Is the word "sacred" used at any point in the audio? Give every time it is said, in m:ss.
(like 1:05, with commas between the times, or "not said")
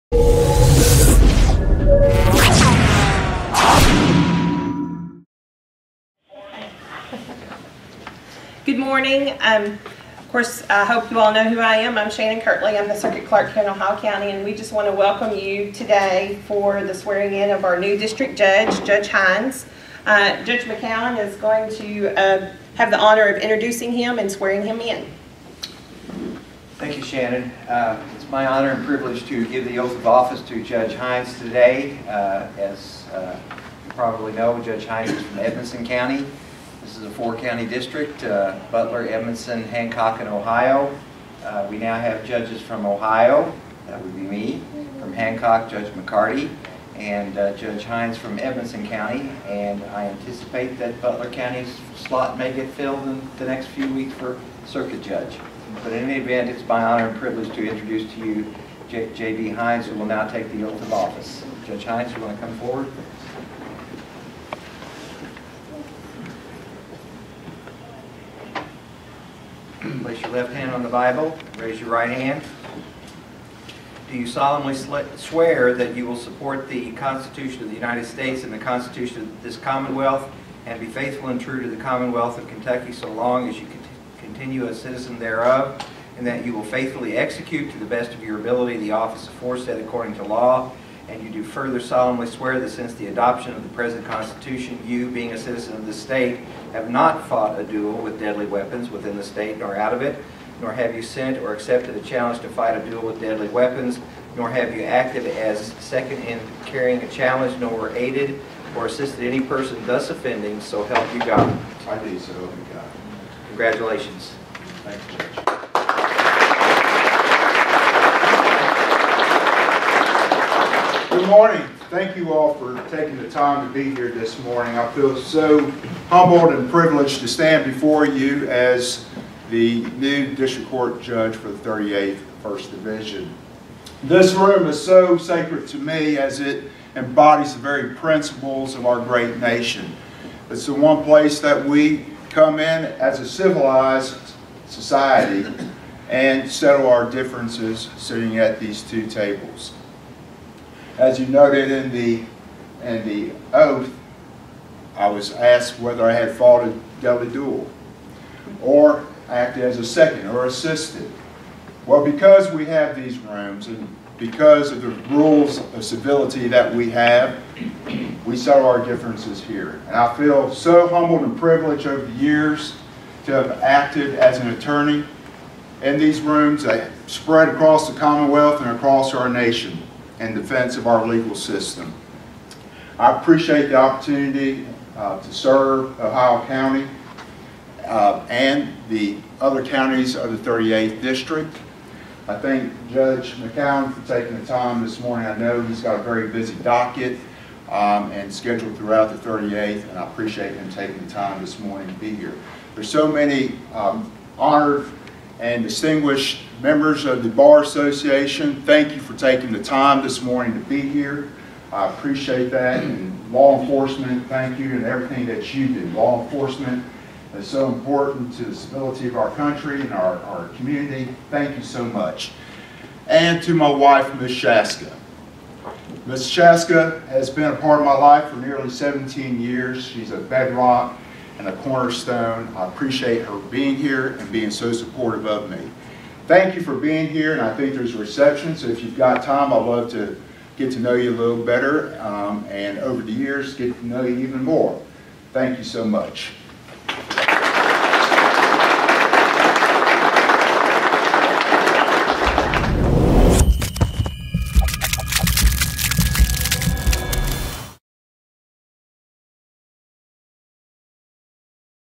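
2:15.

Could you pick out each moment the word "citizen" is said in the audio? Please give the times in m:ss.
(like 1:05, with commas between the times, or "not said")
1:24, 1:35.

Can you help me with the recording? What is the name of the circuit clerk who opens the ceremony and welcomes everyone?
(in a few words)
Shannon Kirtley.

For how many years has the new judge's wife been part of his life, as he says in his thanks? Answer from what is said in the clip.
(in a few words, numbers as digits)
17 years.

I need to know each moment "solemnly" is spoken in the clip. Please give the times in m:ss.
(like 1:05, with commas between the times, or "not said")
1:14, 1:31.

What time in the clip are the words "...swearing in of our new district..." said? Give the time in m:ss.
0:16.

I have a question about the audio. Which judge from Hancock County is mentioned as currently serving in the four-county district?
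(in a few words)
Judge McCarty.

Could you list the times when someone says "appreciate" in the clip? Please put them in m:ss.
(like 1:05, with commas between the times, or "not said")
3:03, 3:20, 3:31, 3:52.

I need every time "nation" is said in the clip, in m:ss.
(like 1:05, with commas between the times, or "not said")
2:19, 2:59.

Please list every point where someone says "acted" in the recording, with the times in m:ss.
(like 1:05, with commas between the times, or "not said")
1:44, 2:39, 2:53.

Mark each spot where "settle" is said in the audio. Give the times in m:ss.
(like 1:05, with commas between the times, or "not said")
2:26, 2:48.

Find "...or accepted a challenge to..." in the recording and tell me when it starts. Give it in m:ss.
1:41.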